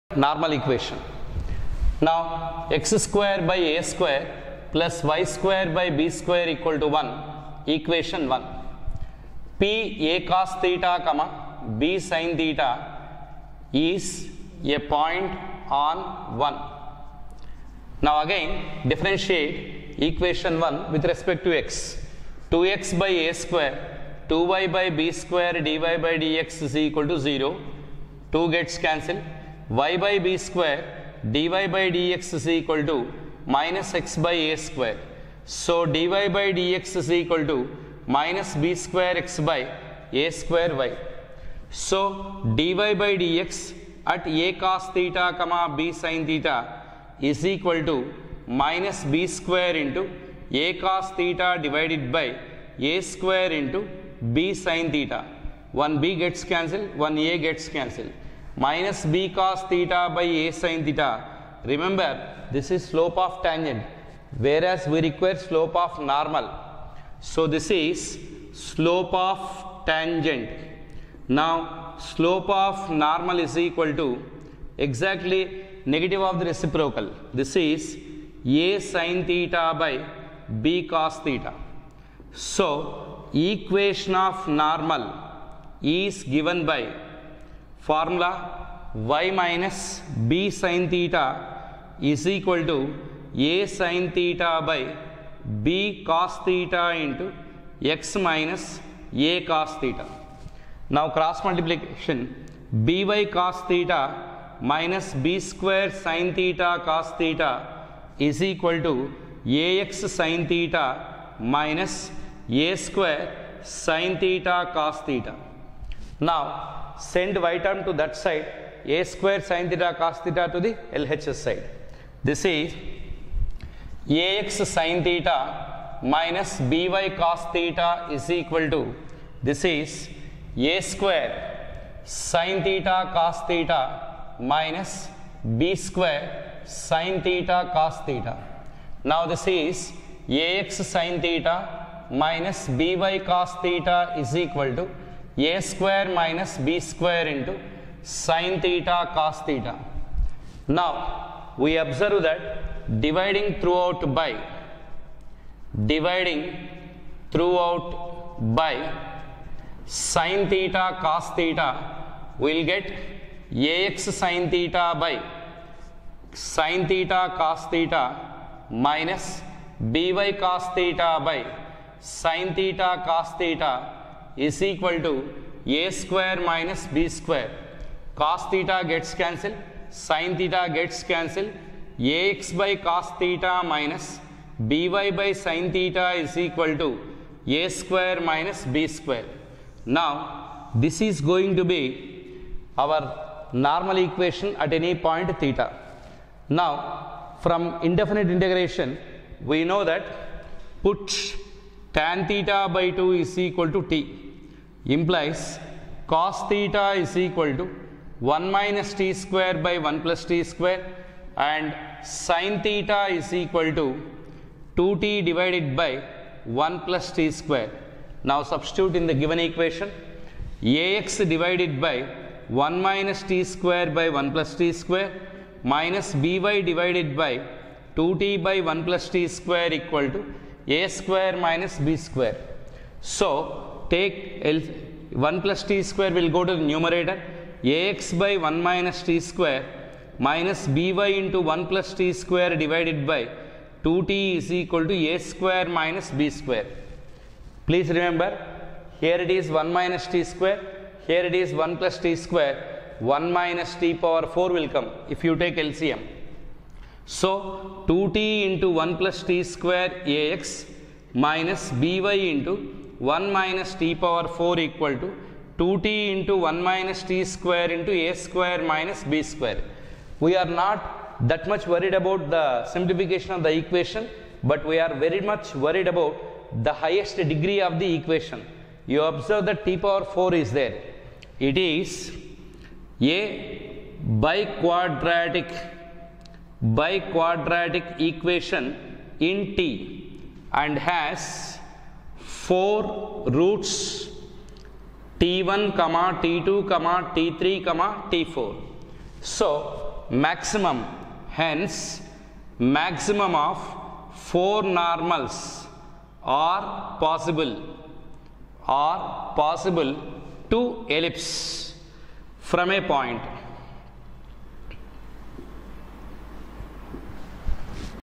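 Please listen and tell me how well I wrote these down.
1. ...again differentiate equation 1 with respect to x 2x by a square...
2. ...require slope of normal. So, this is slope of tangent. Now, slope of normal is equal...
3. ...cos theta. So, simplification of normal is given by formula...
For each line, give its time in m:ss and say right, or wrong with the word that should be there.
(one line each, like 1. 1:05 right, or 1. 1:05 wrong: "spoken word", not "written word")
1. 0:18 right
2. 1:05 right
3. 1:20 wrong: "equation", not "simplification".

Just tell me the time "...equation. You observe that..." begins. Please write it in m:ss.
4:37.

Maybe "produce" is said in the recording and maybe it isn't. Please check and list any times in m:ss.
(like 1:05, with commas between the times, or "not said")
not said.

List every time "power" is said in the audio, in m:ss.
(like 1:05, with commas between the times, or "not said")
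4:13, 4:23, 4:39.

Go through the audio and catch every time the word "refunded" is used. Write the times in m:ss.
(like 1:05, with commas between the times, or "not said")
not said.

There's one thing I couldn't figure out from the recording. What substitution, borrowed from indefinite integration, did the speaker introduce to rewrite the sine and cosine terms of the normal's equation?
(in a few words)
tan θ/2 = t.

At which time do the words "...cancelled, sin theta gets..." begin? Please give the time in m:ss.
2:59.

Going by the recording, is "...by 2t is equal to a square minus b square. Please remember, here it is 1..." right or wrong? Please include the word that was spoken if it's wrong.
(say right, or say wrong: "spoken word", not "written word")
right.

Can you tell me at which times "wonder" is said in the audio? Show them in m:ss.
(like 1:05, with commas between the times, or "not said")
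not said.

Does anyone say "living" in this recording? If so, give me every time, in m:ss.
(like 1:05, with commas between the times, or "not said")
not said.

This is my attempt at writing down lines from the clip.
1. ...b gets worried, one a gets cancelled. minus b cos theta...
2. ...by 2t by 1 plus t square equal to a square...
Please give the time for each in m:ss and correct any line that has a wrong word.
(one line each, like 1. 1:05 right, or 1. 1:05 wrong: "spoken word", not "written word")
1. 0:56 wrong: "cancelled", not "worried"
2. 3:47 right.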